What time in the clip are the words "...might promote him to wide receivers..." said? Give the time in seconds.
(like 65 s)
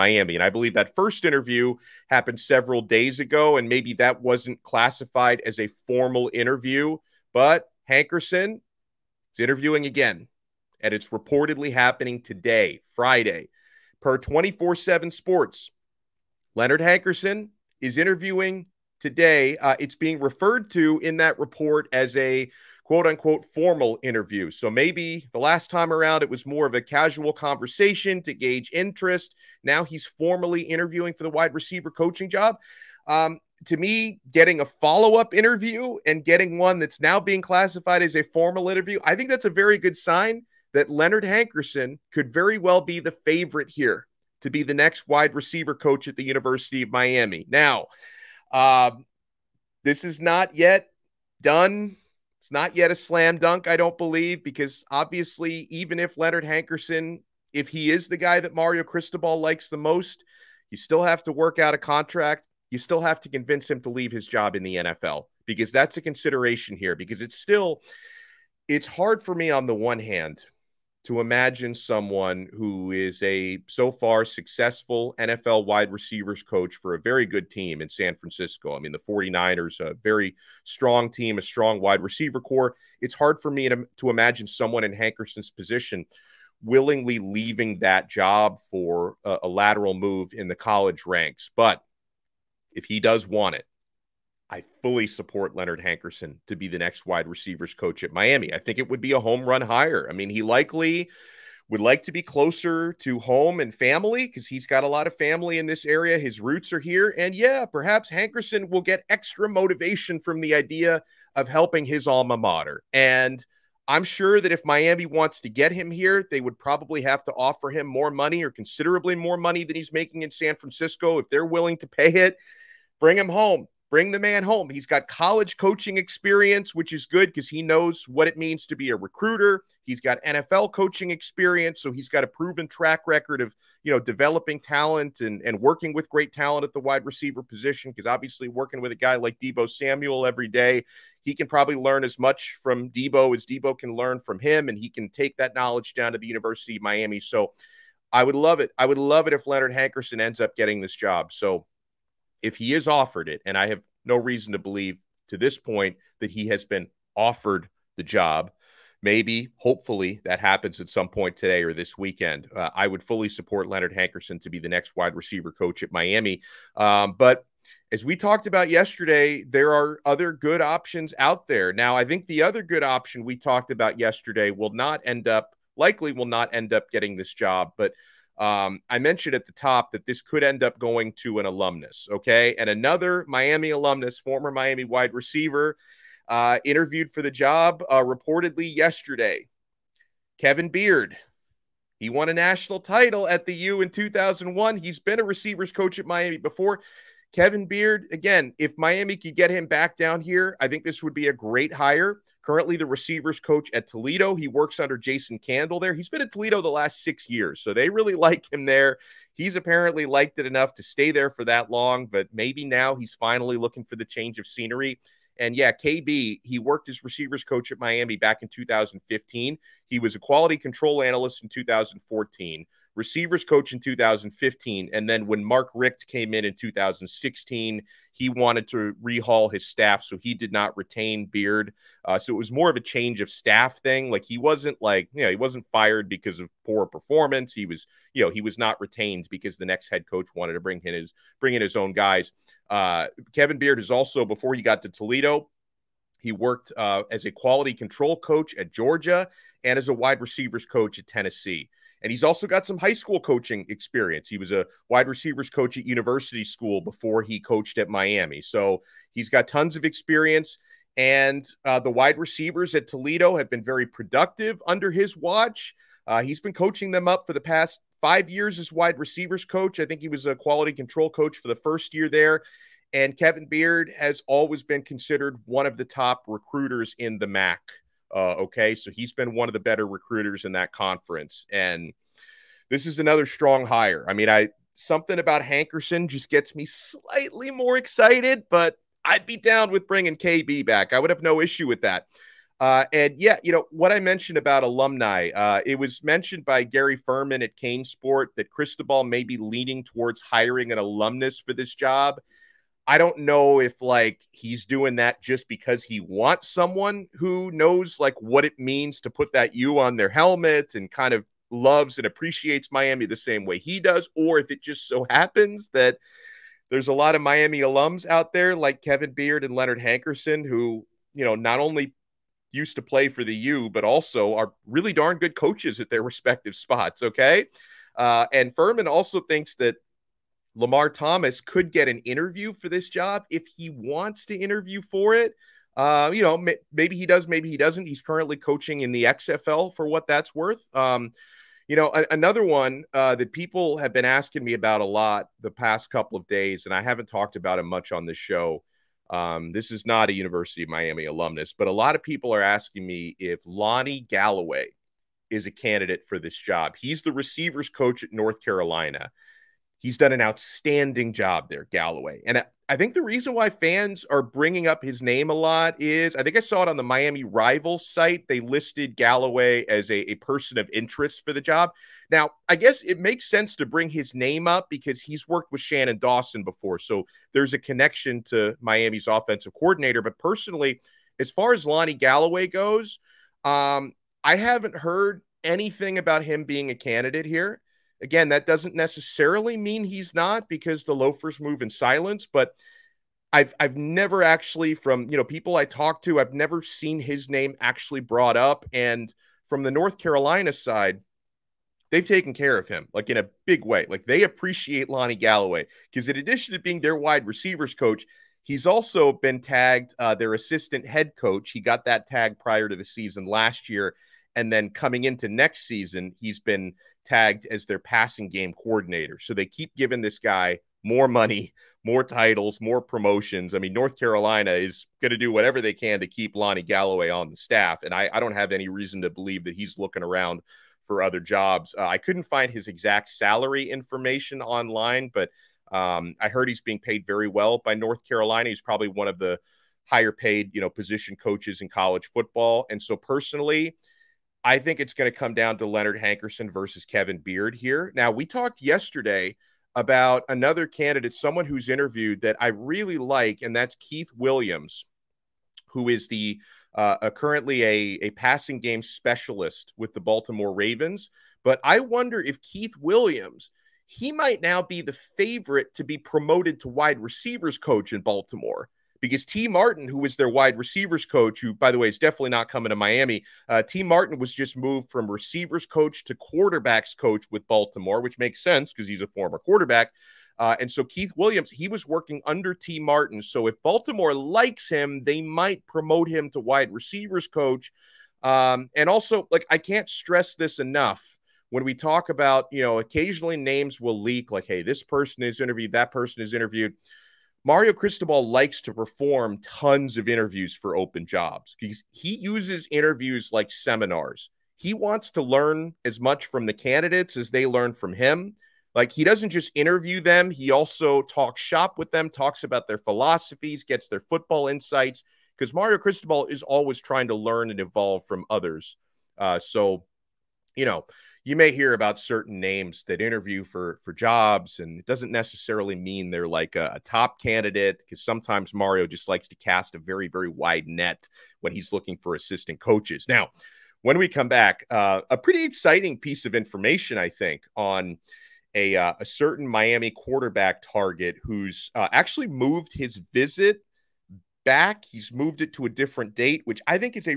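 485 s.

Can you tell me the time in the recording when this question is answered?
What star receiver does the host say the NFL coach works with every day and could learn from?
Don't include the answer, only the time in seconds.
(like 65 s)
139 s.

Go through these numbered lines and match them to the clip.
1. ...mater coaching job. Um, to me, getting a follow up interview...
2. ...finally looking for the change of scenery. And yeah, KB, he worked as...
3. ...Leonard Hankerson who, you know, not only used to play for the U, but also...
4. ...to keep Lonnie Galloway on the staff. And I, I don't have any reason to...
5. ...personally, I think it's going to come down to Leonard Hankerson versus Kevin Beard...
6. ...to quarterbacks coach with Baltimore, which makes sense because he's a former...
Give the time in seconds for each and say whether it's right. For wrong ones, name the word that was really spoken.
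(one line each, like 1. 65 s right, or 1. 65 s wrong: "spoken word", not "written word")
1. 31 s wrong: "receiver", not "mater"
2. 213 s right
3. 319 s right
4. 425 s right
5. 442 s right
6. 476 s right.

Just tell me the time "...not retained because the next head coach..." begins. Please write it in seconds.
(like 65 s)
238 s.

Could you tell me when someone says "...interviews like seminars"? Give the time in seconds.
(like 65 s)
502 s.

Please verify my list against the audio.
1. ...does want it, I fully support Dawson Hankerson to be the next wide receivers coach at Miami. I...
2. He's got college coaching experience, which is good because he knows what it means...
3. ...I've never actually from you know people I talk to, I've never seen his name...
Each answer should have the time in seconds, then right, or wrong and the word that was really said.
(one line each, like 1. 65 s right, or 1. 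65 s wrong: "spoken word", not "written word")
1. 92 s wrong: "Leonard", not "Dawson"
2. 124 s right
3. 393 s right.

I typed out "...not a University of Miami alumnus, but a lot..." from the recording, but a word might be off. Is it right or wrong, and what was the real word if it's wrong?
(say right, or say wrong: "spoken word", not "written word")
right.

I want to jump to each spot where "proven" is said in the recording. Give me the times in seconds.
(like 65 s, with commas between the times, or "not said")
132 s.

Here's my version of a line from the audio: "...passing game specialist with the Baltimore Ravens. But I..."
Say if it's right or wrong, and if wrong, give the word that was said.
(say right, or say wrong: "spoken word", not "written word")
right.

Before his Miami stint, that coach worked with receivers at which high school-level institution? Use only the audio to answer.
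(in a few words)
University School.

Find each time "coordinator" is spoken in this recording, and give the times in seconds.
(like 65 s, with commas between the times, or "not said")
379 s, 418 s.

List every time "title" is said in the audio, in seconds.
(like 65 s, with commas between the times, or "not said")
192 s, 422 s.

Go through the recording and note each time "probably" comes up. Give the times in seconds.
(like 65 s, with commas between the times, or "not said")
116 s, 141 s, 438 s.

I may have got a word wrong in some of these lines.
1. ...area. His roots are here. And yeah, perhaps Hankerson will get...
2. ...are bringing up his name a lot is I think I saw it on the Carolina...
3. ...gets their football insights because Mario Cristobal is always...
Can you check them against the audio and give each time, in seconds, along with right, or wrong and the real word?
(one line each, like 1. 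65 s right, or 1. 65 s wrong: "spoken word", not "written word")
1. 105 s right
2. 364 s wrong: "Miami", not "Carolina"
3. 513 s right.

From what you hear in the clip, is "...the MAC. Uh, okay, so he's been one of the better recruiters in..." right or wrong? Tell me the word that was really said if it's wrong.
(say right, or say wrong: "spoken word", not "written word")
right.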